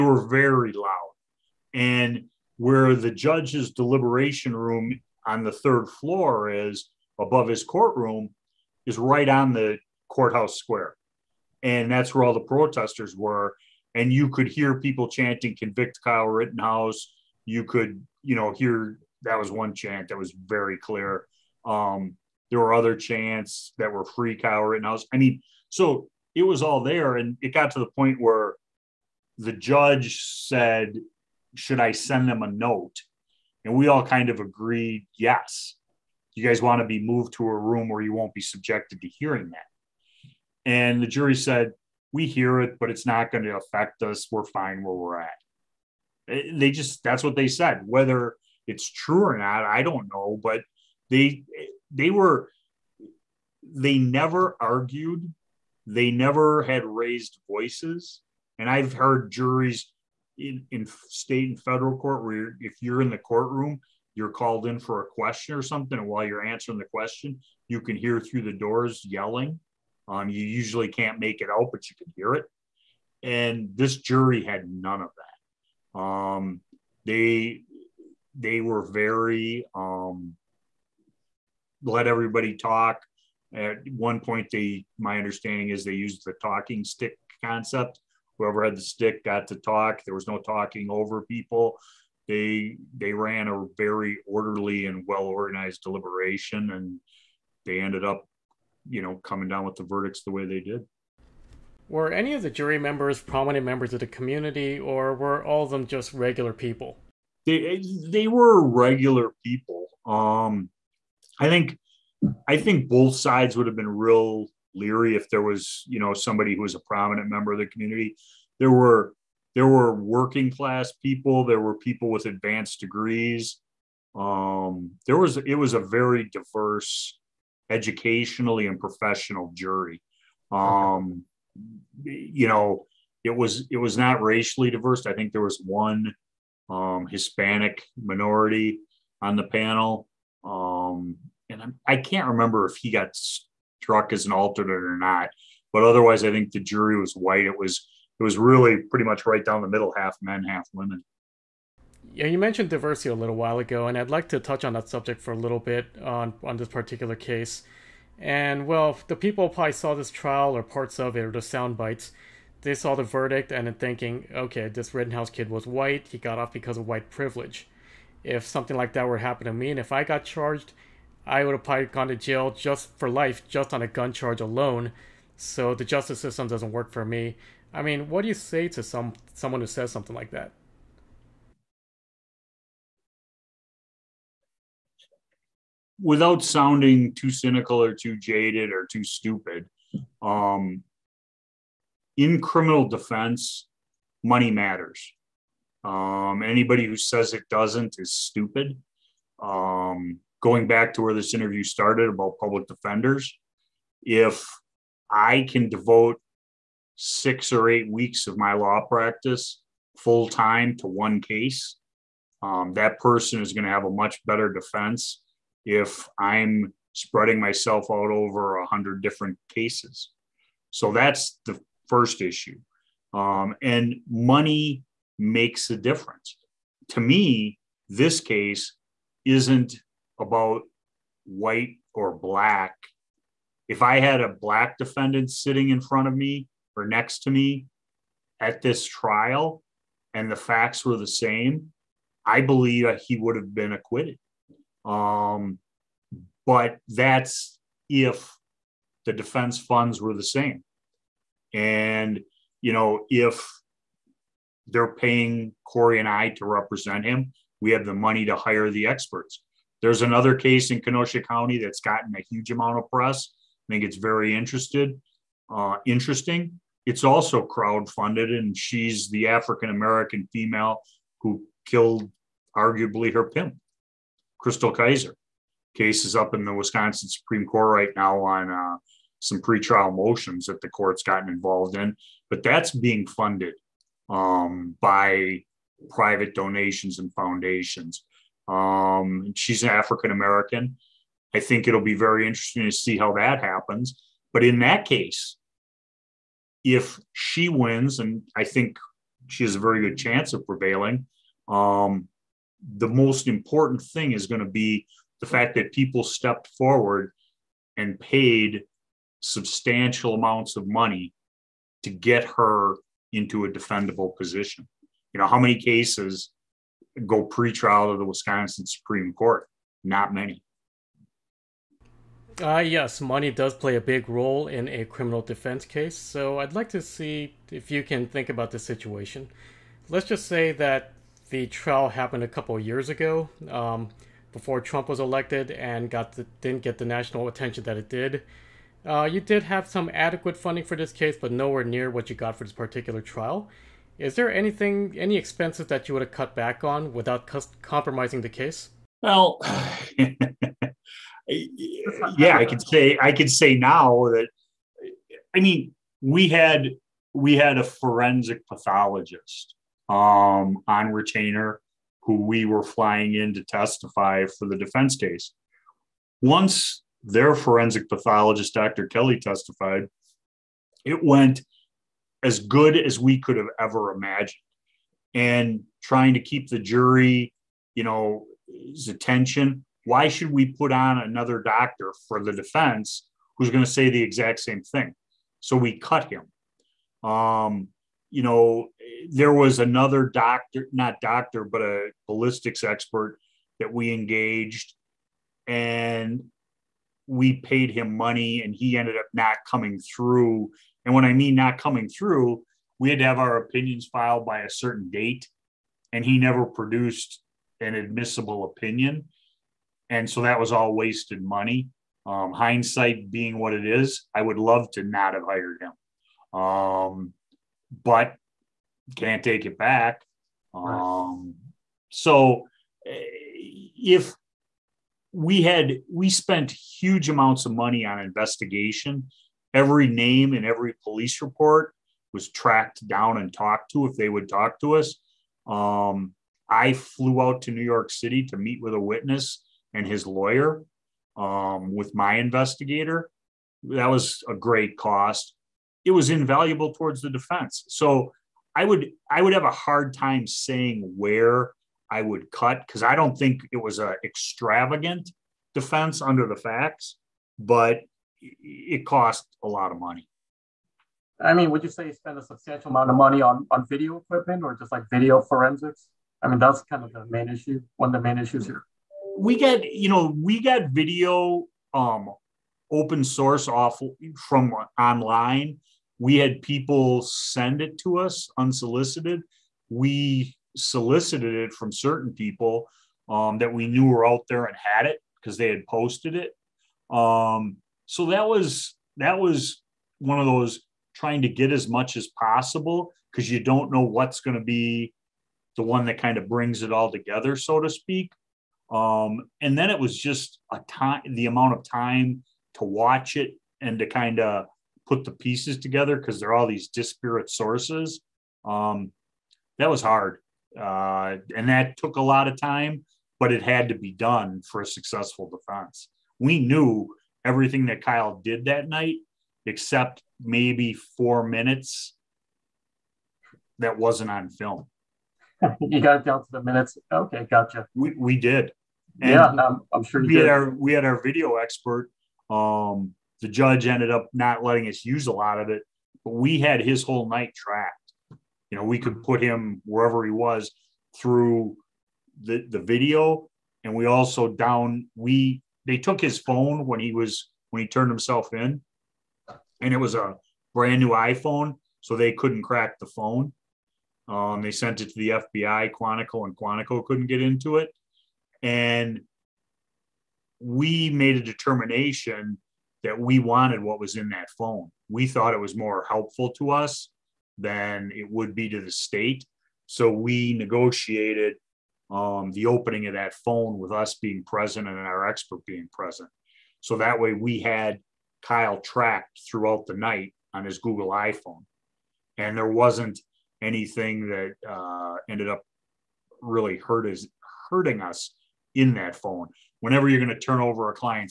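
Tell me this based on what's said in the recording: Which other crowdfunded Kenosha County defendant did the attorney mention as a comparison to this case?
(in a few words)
Chrystul Kizer.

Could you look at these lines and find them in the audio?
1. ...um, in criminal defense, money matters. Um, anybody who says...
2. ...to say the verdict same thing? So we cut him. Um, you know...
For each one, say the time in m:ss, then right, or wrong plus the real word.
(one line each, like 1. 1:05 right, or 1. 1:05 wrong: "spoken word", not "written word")
1. 3:10 right
2. 6:23 wrong: "exact", not "verdict".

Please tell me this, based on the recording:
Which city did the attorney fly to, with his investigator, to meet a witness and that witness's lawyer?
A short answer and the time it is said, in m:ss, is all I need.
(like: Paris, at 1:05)
New York City, at 7:17.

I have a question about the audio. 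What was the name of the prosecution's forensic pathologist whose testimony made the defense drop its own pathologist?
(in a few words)
Dr. Kelly.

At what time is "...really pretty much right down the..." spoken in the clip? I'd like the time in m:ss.
2:28.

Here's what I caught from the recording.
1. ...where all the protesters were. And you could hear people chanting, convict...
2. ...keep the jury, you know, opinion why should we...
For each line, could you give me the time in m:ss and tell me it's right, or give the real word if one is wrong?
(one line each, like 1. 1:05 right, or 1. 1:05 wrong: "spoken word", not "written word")
1. 0:12 right
2. 6:16 wrong: "attention", not "opinion".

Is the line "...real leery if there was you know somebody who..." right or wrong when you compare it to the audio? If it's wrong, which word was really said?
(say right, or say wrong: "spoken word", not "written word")
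right.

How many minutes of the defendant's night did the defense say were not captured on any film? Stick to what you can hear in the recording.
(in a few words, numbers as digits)
4.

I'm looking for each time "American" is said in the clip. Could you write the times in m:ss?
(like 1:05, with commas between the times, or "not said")
4:29, 4:50.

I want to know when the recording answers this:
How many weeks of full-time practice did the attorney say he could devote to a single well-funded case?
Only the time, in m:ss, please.
3:26.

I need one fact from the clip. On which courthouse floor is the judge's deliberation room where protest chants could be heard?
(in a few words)
Third floor.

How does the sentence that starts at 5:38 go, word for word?
Uh, you did have some adequate funding for this case, but nowhere near what you got for this particular trial.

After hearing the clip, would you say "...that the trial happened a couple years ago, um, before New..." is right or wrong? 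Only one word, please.
wrong.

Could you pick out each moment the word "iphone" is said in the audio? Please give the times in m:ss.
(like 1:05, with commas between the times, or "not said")
9:10, 9:40.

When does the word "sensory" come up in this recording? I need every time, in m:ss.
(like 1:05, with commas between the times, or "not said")
not said.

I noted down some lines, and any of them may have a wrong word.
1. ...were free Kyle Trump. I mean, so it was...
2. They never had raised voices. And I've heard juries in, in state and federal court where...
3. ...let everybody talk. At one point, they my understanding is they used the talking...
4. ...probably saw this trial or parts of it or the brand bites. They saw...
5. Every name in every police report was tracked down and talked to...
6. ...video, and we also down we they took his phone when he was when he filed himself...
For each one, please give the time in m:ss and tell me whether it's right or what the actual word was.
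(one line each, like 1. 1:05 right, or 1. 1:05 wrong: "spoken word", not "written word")
1. 0:23 wrong: "Rittenhouse", not "Trump"
2. 0:55 right
3. 1:21 right
4. 2:39 wrong: "sound", not "brand"
5. 7:09 right
6. 9:02 wrong: "turned", not "filed".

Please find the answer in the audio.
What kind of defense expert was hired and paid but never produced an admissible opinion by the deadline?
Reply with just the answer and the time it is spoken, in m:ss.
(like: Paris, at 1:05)
Ballistics expert, at 6:32.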